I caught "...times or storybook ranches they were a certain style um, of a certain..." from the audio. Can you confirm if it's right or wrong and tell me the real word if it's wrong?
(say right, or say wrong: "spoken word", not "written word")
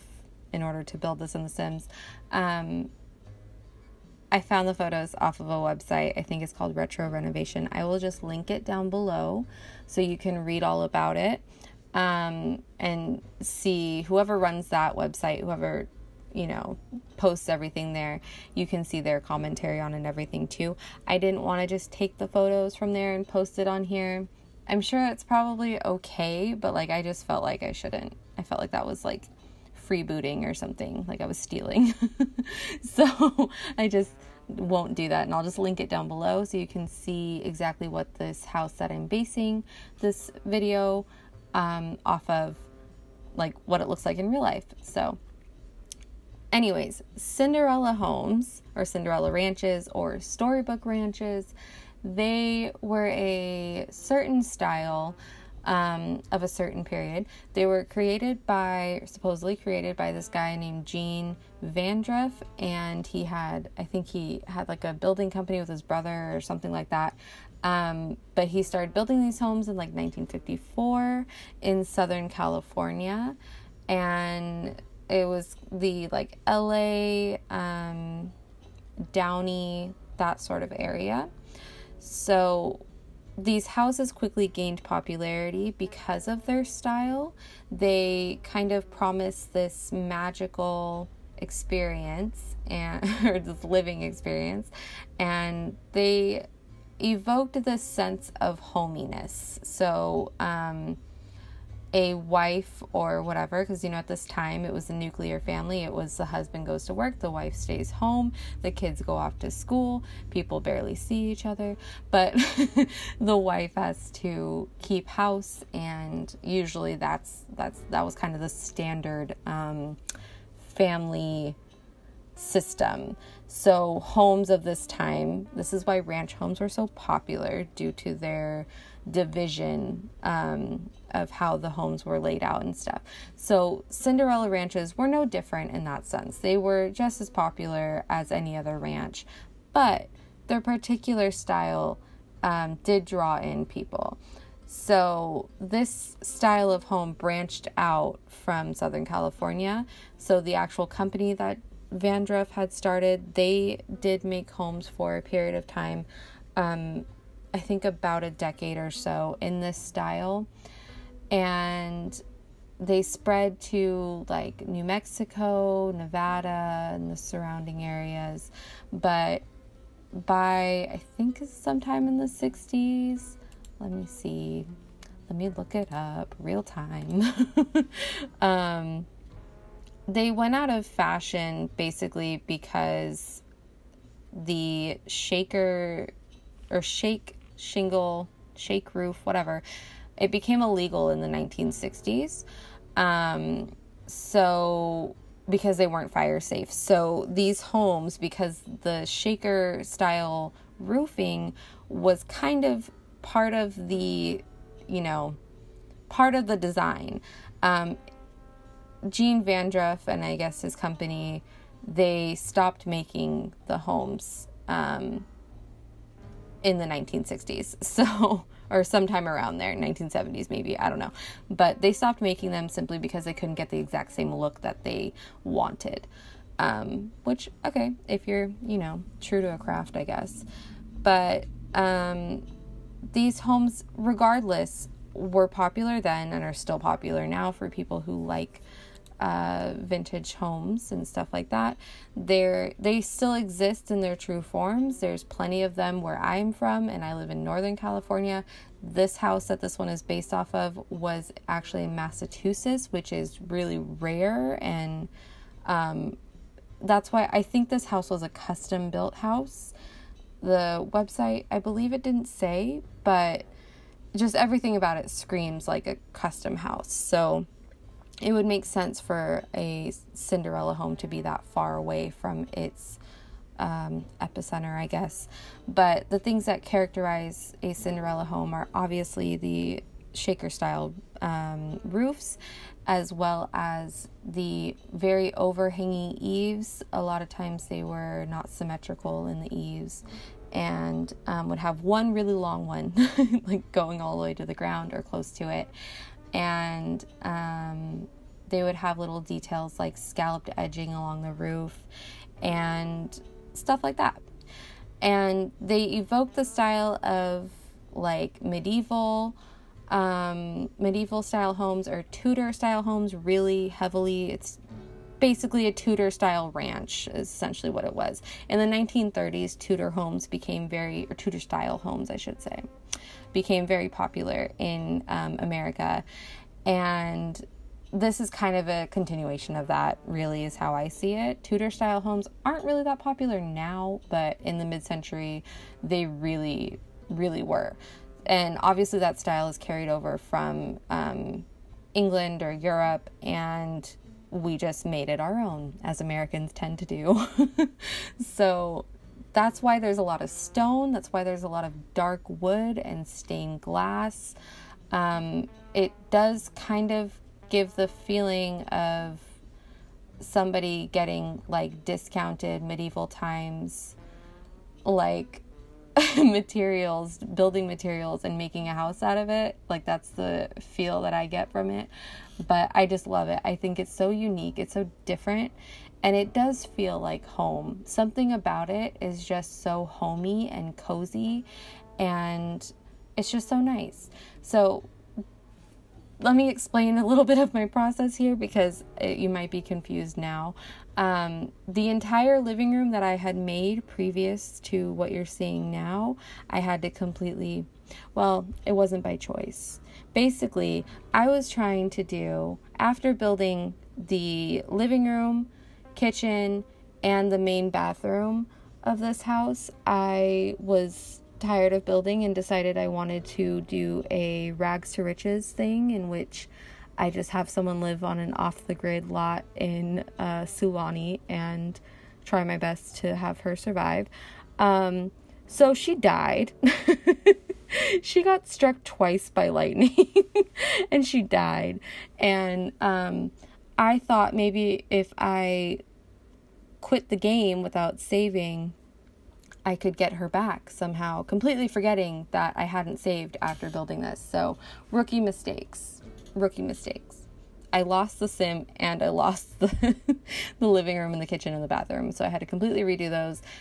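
wrong: "ranches", not "times".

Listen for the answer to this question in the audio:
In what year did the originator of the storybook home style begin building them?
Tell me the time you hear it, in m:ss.
1:09.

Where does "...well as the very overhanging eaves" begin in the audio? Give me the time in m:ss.
4:43.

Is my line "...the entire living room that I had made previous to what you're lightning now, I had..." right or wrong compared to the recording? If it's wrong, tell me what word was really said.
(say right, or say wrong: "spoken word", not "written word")
wrong: "seeing", not "lightning".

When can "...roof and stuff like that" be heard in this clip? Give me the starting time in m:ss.
5:01.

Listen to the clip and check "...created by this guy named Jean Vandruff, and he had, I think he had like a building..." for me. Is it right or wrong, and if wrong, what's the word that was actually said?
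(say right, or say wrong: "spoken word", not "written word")
right.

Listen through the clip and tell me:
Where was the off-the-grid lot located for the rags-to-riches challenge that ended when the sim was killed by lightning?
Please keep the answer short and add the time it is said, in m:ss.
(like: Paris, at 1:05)
Sulani, at 7:00.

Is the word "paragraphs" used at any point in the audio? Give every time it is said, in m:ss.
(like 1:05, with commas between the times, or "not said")
not said.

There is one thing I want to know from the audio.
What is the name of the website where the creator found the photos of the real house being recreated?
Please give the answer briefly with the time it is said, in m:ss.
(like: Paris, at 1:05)
Retro Renovation, at 0:06.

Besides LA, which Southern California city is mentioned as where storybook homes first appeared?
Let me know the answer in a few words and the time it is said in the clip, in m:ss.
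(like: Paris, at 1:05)
Downey, at 1:19.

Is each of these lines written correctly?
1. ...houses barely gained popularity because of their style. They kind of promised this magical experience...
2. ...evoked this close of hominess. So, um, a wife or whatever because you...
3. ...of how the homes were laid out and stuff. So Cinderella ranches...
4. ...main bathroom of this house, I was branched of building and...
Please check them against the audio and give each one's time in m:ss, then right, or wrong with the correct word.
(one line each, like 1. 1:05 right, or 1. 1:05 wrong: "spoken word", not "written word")
1. 1:23 wrong: "quickly", not "barely"
2. 1:37 wrong: "sense", not "close"
3. 2:11 right
4. 6:47 wrong: "tired", not "branched".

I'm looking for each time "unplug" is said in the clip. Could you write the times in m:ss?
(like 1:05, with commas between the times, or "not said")
not said.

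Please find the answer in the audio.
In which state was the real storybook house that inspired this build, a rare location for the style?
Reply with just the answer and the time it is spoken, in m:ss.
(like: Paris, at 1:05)
Massachusetts, at 4:11.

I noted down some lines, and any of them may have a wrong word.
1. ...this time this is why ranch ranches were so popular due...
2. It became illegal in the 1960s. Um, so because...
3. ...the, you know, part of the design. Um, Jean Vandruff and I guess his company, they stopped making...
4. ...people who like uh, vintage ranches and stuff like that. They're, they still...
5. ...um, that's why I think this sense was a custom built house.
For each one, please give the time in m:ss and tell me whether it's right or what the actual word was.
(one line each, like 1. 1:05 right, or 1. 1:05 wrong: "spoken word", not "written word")
1. 2:04 wrong: "homes", not "ranches"
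2. 3:10 right
3. 3:23 right
4. 3:57 wrong: "homes", not "ranches"
5. 4:15 wrong: "house", not "sense".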